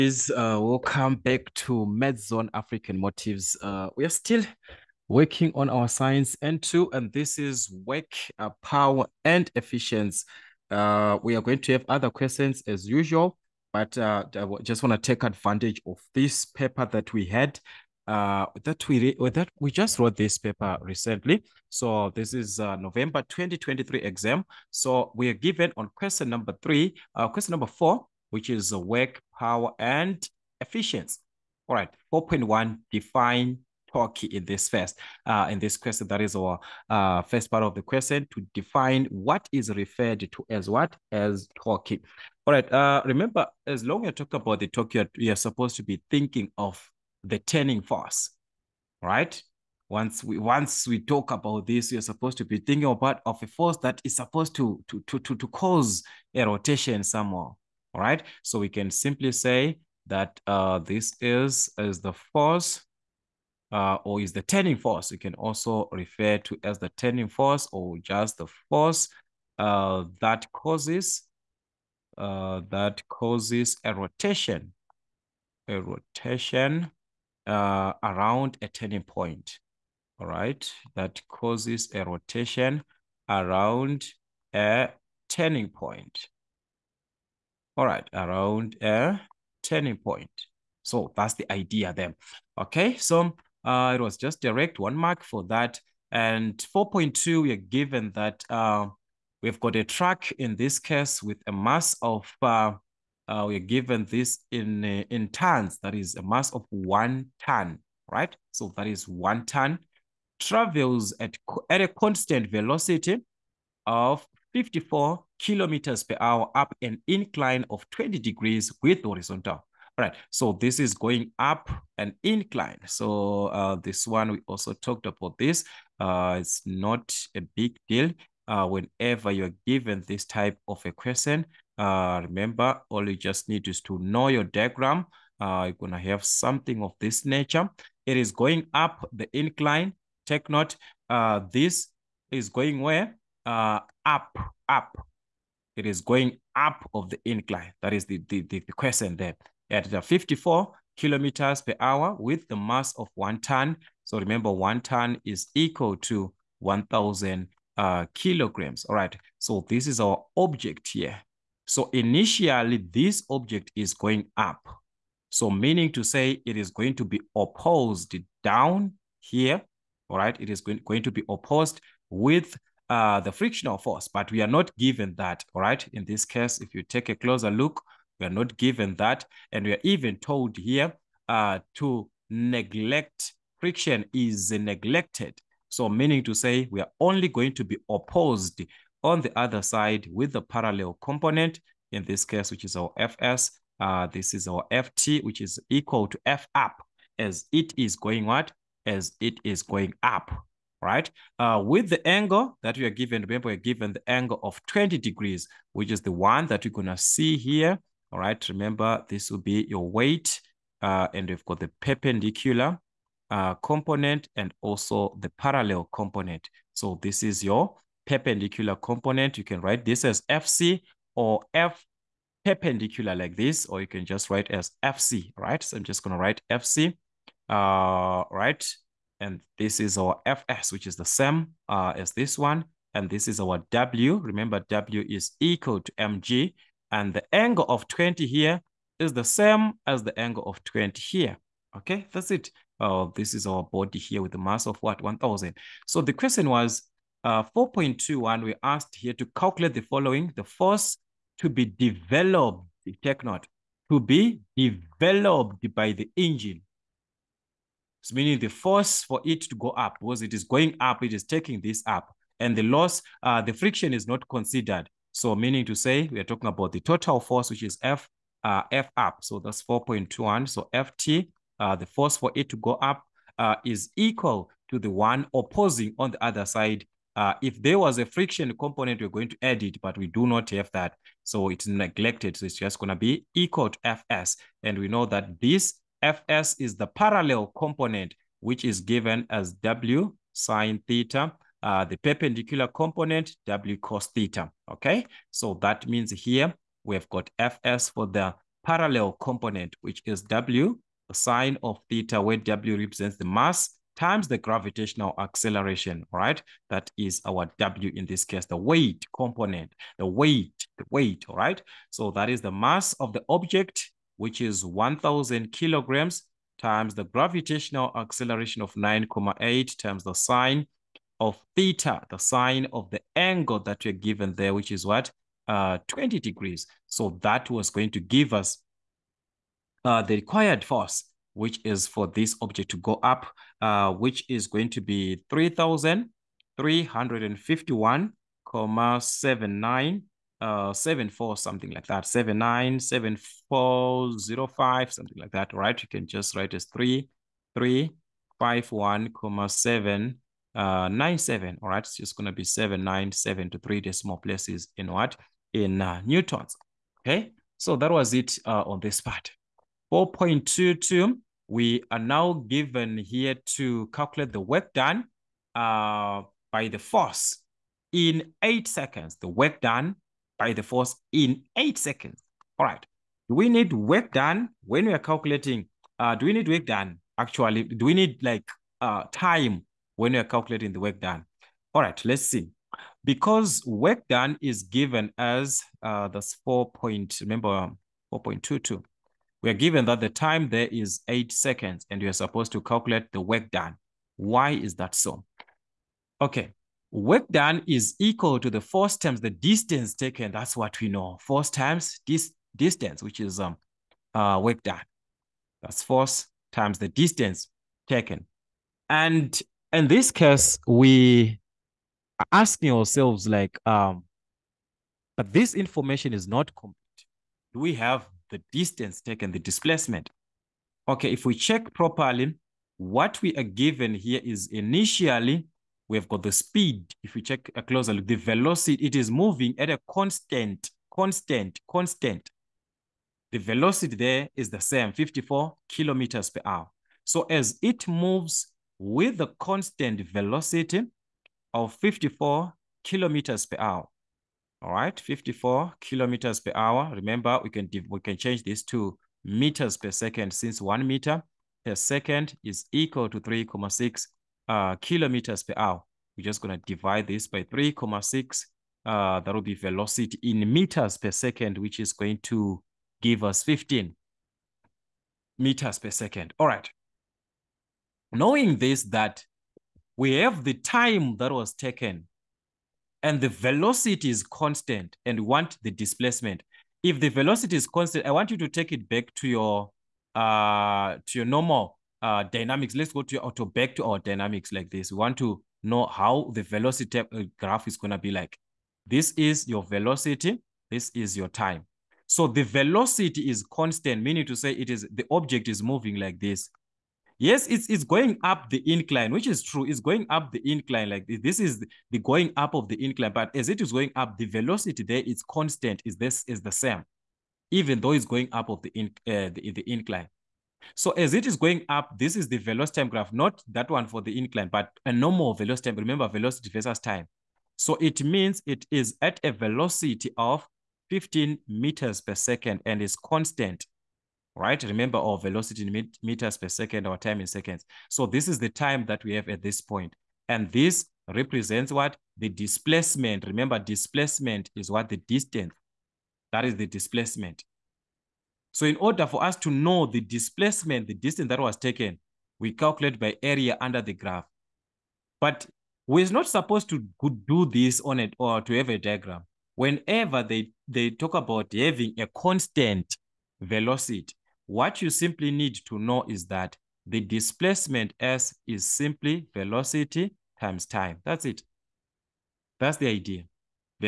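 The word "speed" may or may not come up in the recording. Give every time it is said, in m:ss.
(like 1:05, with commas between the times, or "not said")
7:06.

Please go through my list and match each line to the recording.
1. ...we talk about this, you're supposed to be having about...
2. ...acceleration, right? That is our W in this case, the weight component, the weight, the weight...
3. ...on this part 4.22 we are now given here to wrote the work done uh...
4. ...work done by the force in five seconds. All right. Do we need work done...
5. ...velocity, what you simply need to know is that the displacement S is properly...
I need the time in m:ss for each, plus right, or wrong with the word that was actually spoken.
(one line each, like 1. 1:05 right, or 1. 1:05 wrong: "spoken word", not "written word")
1. 0:50 wrong: "thinking", not "having"
2. 5:05 right
3. 5:58 wrong: "calculate", not "wrote"
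4. 6:09 wrong: "eight", not "five"
5. 9:13 wrong: "simply", not "properly".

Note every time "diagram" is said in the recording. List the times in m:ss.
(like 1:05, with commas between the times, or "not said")
2:14, 9:08.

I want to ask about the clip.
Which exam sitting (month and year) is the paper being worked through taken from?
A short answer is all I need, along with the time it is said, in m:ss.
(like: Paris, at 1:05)
November 2023, at 0:22.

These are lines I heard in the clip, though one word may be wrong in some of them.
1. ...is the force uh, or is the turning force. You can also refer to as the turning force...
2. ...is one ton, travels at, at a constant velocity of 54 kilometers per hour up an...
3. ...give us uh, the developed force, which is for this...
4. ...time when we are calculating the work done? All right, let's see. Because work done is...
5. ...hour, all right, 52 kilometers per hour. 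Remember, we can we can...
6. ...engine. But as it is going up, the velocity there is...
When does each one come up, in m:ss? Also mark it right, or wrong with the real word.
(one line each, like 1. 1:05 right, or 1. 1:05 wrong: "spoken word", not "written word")
1. 1:01 right
2. 1:48 right
3. 5:27 wrong: "required", not "developed"
4. 6:19 right
5. 7:23 wrong: "54", not "52"
6. 8:22 wrong: "incline", not "engine".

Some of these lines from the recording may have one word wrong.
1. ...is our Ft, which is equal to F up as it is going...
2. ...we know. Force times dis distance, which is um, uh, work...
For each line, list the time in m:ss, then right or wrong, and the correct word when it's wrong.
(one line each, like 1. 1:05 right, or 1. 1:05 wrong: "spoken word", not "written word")
1. 3:14 right
2. 6:40 right.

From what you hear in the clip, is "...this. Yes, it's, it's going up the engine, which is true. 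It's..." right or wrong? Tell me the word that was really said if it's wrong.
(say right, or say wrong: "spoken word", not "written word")
wrong: "incline", not "engine".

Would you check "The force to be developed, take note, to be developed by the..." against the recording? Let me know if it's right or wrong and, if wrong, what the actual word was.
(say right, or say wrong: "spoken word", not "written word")
right.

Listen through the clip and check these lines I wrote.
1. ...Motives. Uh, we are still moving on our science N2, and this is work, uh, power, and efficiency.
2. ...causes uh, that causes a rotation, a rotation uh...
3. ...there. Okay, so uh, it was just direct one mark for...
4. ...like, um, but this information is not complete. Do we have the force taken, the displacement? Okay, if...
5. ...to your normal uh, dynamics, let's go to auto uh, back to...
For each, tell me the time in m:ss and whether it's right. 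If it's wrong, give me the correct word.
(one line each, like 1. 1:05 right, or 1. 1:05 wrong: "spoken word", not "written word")
1. 0:02 wrong: "working", not "moving"
2. 1:10 right
3. 1:31 right
4. 6:53 wrong: "distance", not "force"
5. 8:01 right.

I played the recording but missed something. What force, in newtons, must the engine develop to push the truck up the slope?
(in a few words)
3351,797 N.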